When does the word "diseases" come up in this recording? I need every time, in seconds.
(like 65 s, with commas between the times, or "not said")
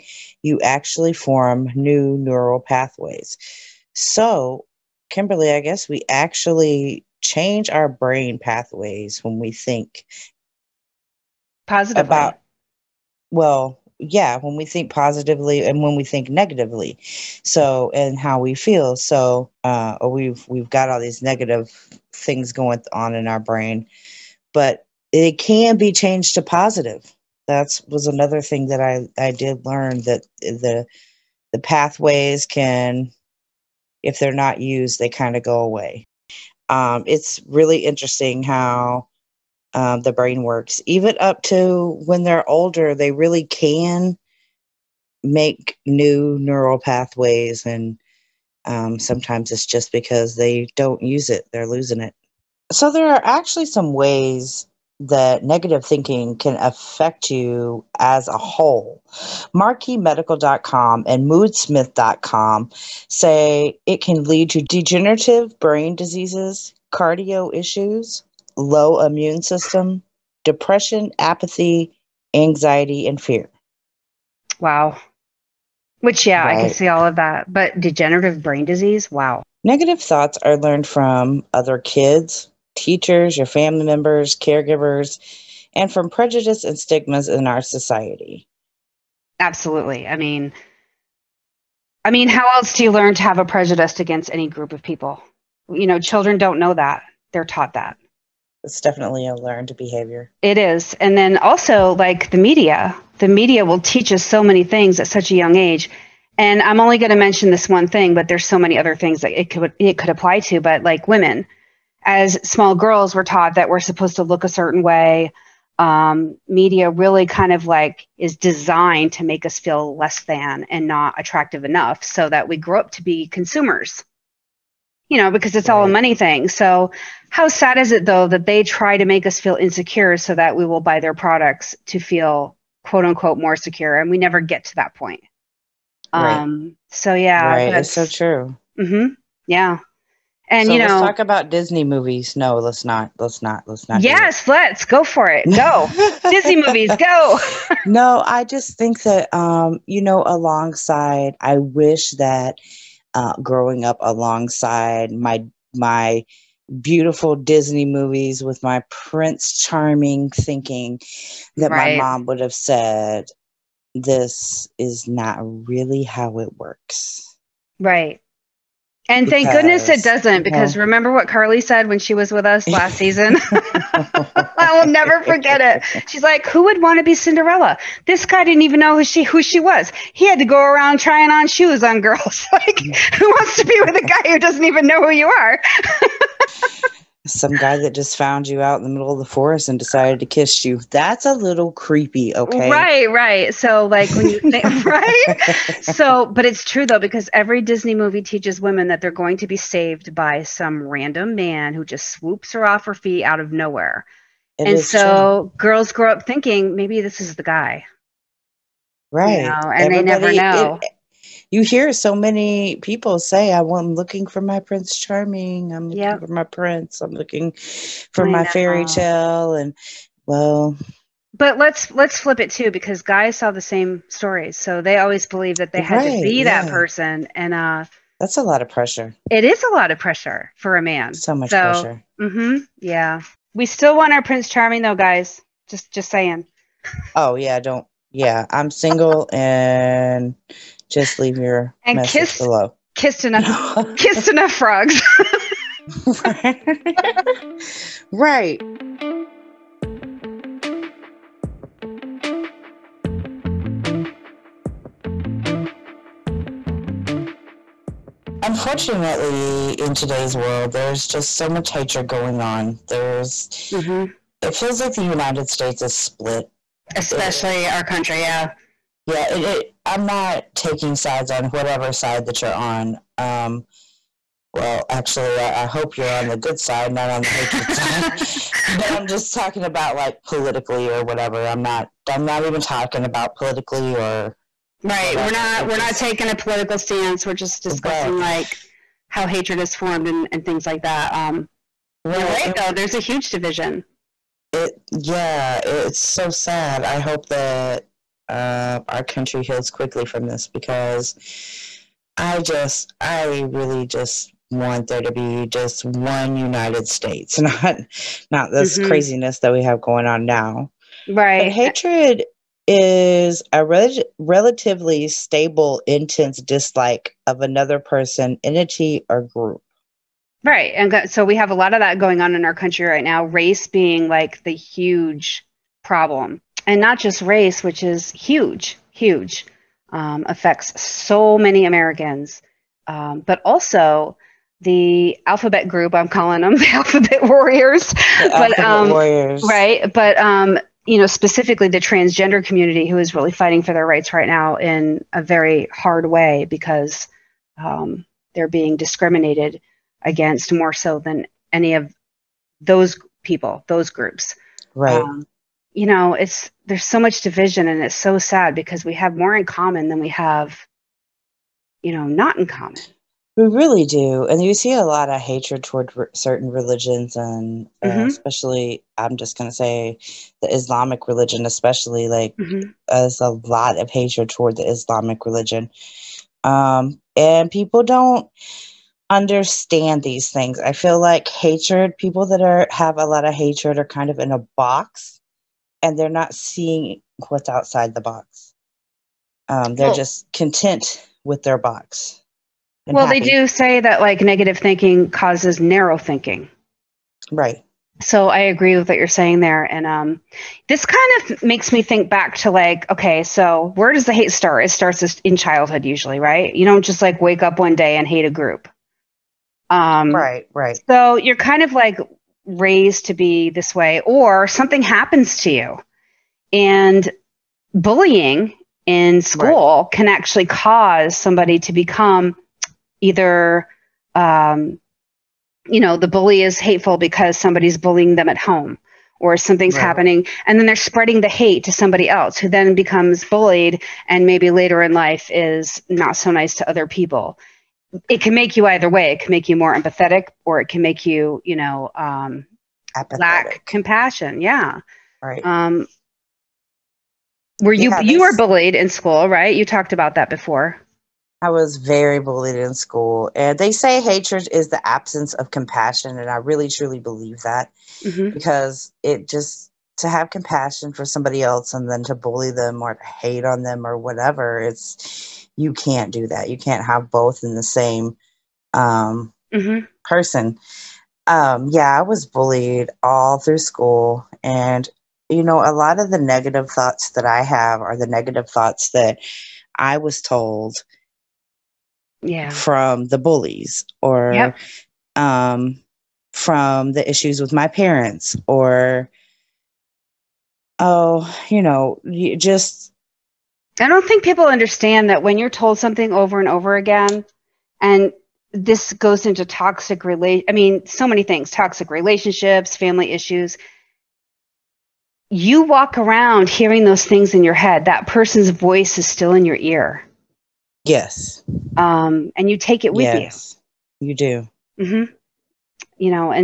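65 s, 78 s.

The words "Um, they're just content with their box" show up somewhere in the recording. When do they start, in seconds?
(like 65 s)
389 s.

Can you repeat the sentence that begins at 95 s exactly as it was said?
You know, children don't know that.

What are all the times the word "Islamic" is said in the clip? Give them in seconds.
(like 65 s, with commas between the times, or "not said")
370 s, 374 s.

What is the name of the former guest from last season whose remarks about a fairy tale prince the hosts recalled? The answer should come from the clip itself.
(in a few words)
Carly.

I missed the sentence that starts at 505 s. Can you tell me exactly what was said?
You walk around hearing those things in your head.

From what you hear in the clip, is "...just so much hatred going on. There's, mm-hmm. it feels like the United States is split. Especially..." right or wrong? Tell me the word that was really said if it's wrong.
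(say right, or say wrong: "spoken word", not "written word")
right.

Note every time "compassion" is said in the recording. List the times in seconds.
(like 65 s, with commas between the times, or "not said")
443 s, 455 s, 460 s.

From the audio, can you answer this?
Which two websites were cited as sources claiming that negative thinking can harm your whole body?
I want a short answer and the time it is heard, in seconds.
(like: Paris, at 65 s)
MarqueeMedical.com and Moodsmith.com, at 59 s.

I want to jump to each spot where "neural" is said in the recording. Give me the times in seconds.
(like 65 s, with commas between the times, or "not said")
2 s, 46 s.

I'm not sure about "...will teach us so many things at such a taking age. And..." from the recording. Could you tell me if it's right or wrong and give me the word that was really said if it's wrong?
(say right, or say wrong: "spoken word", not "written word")
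wrong: "young", not "taking".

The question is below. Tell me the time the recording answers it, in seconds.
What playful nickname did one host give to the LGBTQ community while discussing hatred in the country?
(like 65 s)
336 s.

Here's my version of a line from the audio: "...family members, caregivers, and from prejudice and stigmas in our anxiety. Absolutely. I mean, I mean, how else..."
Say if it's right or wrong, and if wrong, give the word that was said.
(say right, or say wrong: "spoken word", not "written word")
wrong: "society", not "anxiety".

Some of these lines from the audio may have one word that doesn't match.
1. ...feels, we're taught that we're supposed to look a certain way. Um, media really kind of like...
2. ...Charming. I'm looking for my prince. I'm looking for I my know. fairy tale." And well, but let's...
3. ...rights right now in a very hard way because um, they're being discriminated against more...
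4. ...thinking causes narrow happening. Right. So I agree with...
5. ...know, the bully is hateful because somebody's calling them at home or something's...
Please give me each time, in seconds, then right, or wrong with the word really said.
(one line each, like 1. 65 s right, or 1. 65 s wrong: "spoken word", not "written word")
1. 112 s wrong: "girls", not "feels"
2. 214 s right
3. 343 s right
4. 394 s wrong: "thinking", not "happening"
5. 425 s wrong: "bullying", not "calling".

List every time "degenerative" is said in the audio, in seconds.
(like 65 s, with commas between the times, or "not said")
64 s, 77 s.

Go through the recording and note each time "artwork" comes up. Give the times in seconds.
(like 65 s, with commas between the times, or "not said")
not said.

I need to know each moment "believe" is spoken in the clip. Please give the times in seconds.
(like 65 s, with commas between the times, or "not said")
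225 s, 456 s.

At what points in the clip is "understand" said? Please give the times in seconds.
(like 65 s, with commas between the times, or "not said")
379 s, 494 s.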